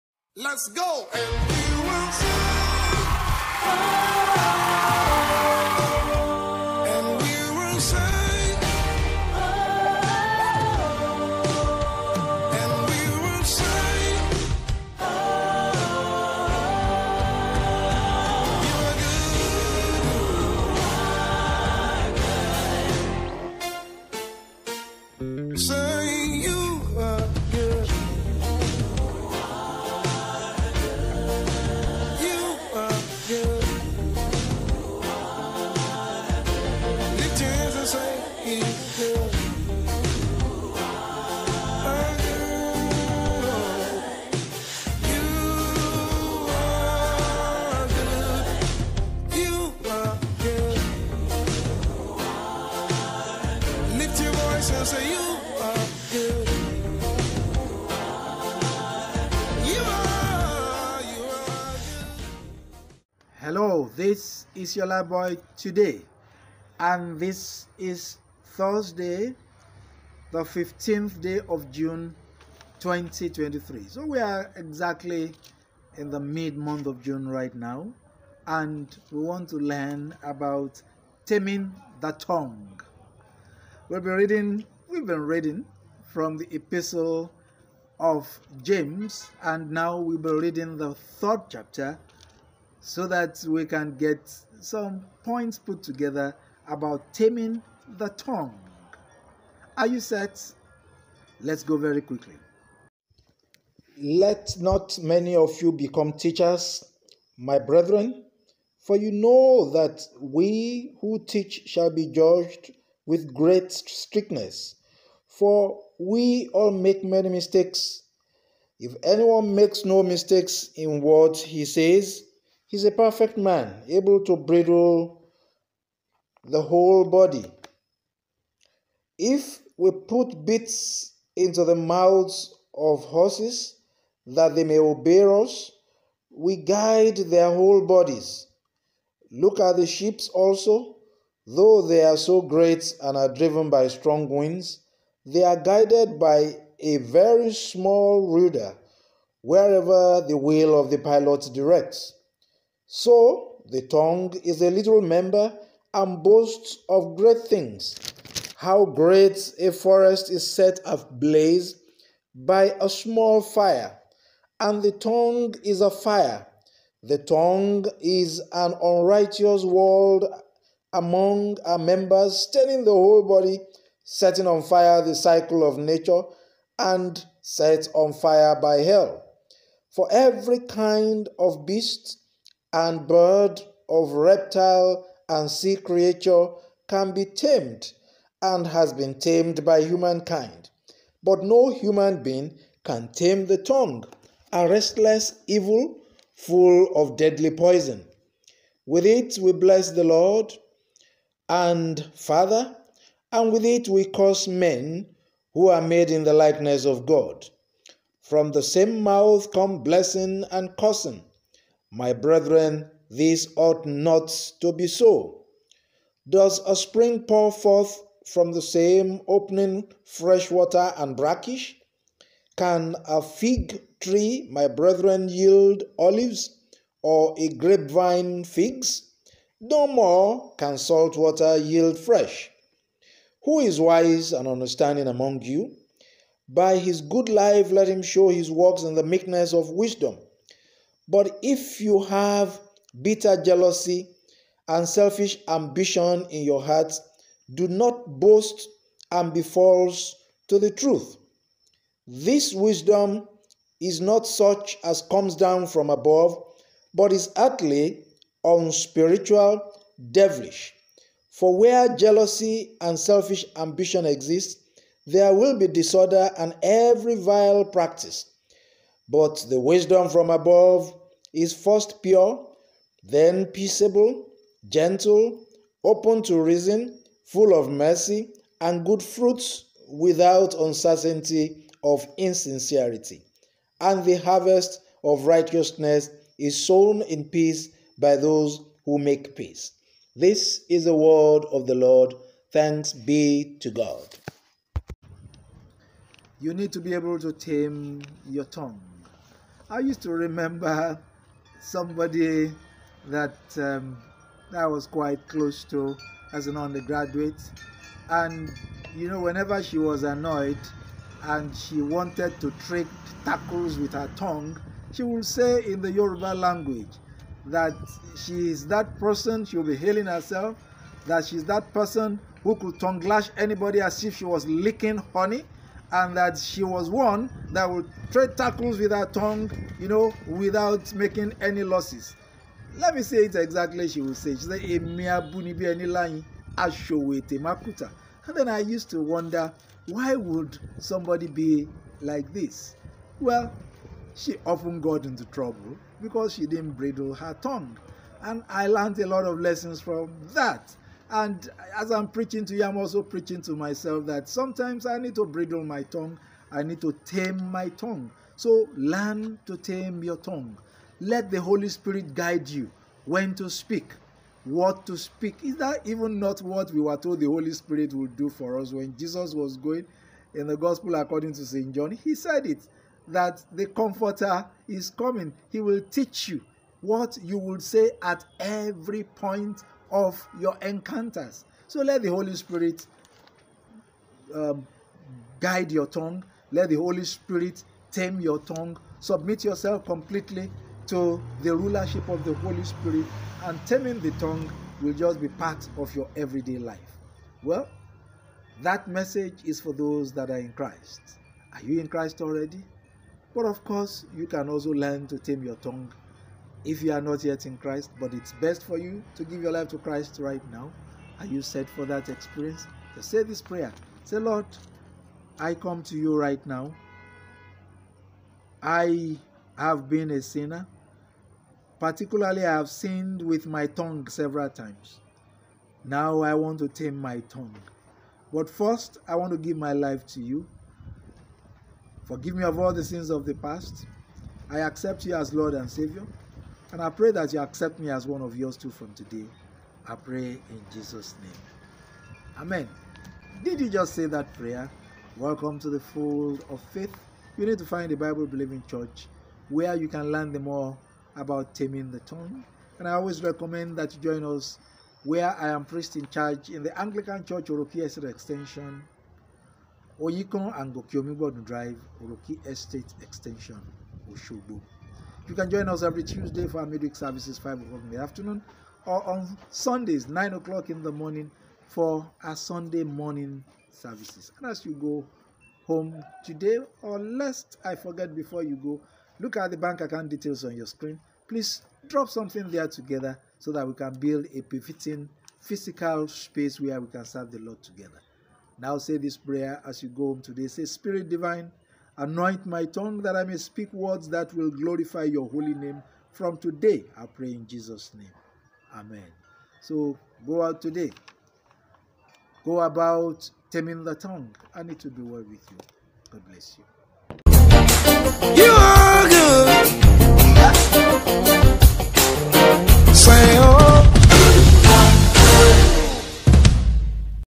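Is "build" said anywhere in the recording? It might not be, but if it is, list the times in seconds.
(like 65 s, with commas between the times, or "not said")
483 s.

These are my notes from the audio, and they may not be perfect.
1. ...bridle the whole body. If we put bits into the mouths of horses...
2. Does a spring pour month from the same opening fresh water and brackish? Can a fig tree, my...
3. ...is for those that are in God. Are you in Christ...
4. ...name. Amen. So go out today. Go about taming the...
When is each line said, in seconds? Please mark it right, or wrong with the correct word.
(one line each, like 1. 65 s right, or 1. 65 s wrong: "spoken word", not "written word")
1. 124 s right
2. 216 s wrong: "forth", not "month"
3. 399 s wrong: "Christ", not "God"
4. 497 s right.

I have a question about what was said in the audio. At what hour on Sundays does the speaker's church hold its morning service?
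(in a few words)
9 o'clock.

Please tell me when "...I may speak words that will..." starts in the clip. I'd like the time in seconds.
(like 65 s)
493 s.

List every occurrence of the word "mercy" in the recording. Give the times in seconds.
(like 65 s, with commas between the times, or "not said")
277 s.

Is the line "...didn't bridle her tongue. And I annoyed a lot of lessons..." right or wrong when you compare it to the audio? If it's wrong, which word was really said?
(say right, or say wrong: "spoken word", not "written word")
wrong: "learned", not "annoyed".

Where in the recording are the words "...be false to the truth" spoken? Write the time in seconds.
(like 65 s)
249 s.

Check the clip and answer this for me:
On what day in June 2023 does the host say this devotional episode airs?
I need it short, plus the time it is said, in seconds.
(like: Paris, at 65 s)
15, at 70 s.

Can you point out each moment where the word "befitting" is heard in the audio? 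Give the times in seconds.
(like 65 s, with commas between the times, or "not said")
484 s.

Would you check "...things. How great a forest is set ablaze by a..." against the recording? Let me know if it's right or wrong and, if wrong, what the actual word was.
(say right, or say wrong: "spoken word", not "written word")
right.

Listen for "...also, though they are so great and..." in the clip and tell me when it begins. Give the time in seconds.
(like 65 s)
140 s.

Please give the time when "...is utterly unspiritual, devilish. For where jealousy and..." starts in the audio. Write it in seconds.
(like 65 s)
257 s.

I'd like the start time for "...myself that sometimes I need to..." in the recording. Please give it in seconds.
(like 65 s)
353 s.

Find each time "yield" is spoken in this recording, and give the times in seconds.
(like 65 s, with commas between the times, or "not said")
225 s, 231 s.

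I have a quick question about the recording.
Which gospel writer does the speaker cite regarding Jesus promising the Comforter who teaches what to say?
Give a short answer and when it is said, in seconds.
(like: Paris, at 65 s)
St. John, at 371 s.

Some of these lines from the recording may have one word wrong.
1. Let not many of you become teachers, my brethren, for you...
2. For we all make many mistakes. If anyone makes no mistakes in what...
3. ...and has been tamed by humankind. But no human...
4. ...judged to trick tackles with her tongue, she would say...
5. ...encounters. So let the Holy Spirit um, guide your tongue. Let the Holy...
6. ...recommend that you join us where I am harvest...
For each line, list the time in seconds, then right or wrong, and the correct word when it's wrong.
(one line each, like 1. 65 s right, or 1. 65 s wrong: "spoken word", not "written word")
1. 103 s right
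2. 115 s right
3. 188 s right
4. 311 s wrong: "wanted", not "judged"
5. 380 s right
6. 453 s wrong: "priest", not "harvest".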